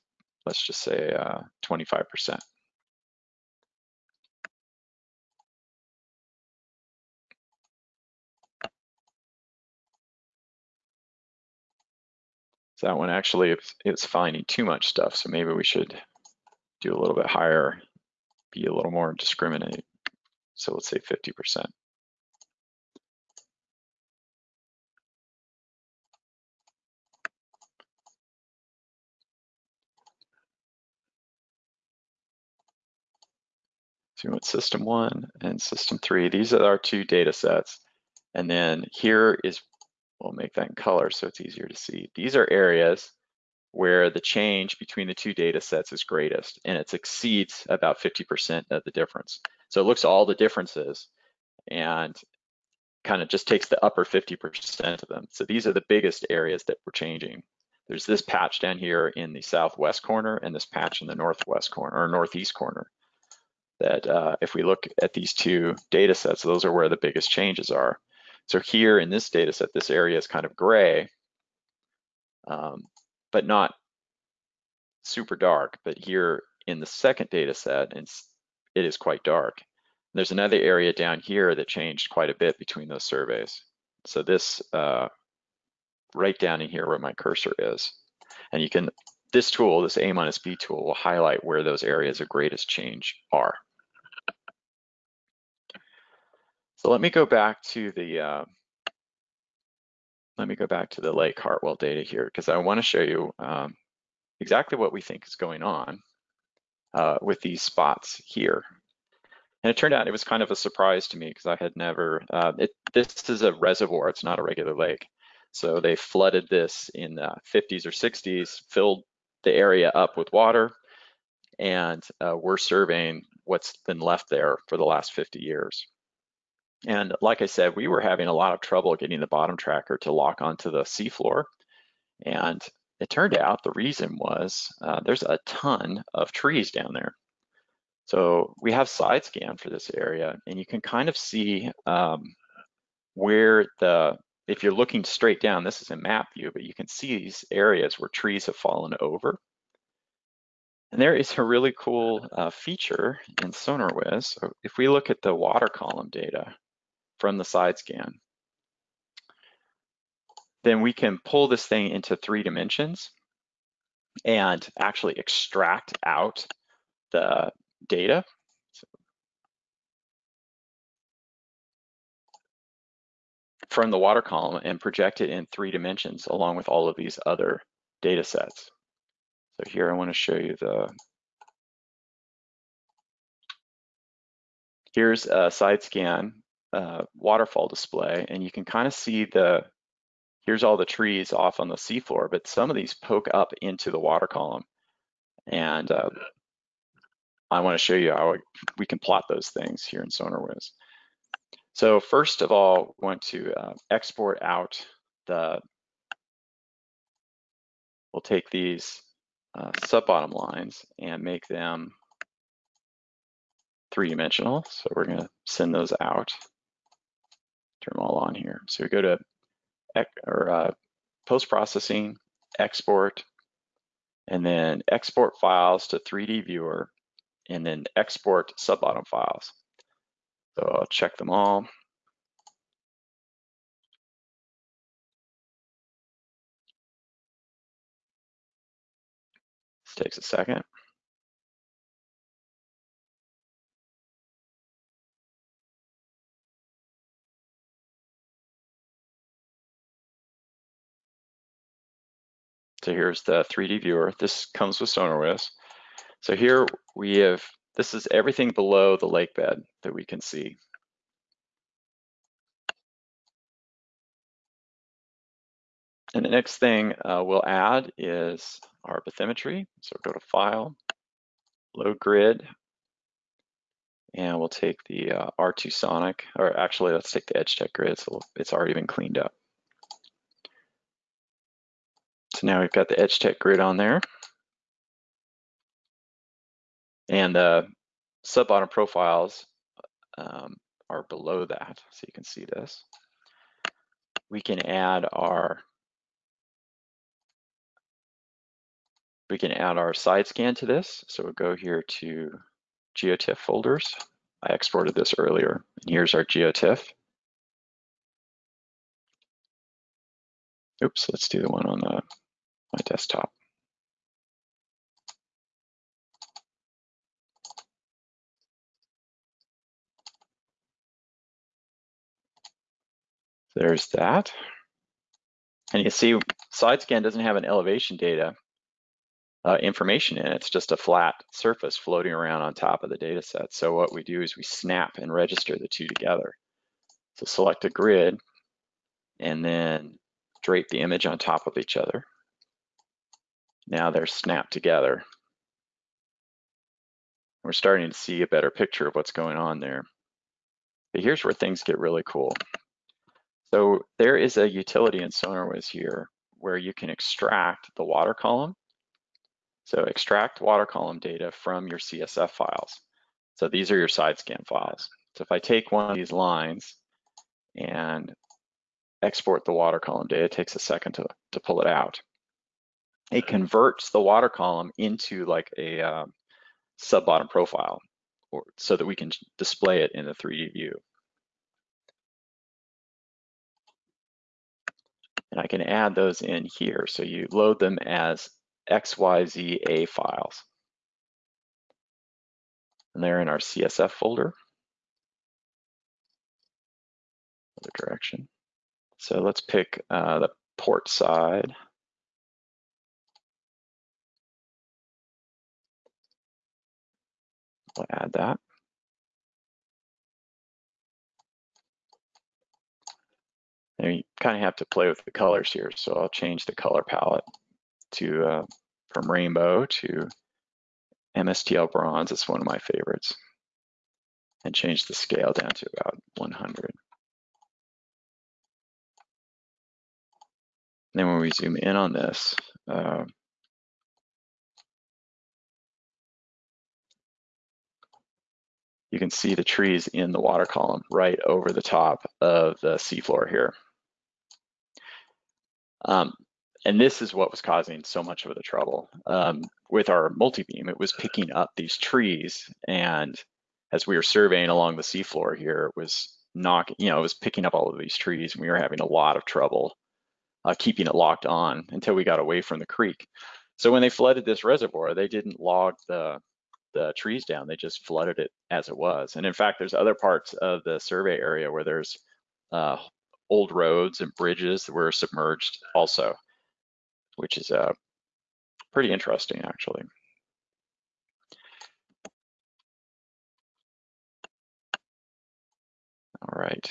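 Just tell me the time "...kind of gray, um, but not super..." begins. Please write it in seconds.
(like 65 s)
70 s.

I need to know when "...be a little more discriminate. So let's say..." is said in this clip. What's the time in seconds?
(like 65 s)
18 s.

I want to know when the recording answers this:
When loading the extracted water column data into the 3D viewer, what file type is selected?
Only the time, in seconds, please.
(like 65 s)
388 s.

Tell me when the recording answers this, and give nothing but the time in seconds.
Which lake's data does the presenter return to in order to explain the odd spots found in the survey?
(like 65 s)
101 s.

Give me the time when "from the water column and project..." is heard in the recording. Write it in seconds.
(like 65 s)
173 s.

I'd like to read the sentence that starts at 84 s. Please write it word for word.
So this uh, right down in here where my cursor is.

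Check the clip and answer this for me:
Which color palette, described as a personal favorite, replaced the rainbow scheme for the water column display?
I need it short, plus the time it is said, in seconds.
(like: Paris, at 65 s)
MSTL bronze, at 421 s.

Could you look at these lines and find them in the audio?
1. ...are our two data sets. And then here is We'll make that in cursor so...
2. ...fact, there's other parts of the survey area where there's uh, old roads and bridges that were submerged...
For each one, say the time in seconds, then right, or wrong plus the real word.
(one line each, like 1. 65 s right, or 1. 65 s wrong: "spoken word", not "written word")
1. 36 s wrong: "color", not "cursor"
2. 469 s right.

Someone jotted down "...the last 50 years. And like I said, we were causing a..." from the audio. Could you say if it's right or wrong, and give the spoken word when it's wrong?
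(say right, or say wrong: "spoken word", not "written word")
wrong: "having", not "causing".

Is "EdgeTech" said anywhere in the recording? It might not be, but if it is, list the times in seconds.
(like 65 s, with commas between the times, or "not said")
277 s, 282 s.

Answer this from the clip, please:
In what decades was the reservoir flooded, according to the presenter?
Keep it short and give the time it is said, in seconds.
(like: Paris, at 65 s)
50s or 60s, at 117 s.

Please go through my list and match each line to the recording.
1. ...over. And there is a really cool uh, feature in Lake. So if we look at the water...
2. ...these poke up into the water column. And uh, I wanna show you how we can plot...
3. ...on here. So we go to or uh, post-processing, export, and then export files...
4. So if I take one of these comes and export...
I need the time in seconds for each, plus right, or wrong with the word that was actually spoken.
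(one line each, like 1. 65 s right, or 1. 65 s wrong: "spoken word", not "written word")
1. 149 s wrong: "SonarWiz", not "Lake"
2. 192 s right
3. 218 s right
4. 365 s wrong: "lines", not "comes".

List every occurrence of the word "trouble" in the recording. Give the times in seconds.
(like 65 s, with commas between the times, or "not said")
128 s, 448 s, 459 s.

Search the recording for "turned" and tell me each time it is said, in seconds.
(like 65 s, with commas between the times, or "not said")
109 s, 133 s.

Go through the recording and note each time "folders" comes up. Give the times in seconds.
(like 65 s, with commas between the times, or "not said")
303 s, 393 s.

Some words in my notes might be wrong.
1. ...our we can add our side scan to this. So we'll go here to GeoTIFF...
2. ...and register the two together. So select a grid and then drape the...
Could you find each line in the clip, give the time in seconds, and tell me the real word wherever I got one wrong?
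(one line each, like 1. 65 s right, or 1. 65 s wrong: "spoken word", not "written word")
1. 295 s right
2. 334 s right.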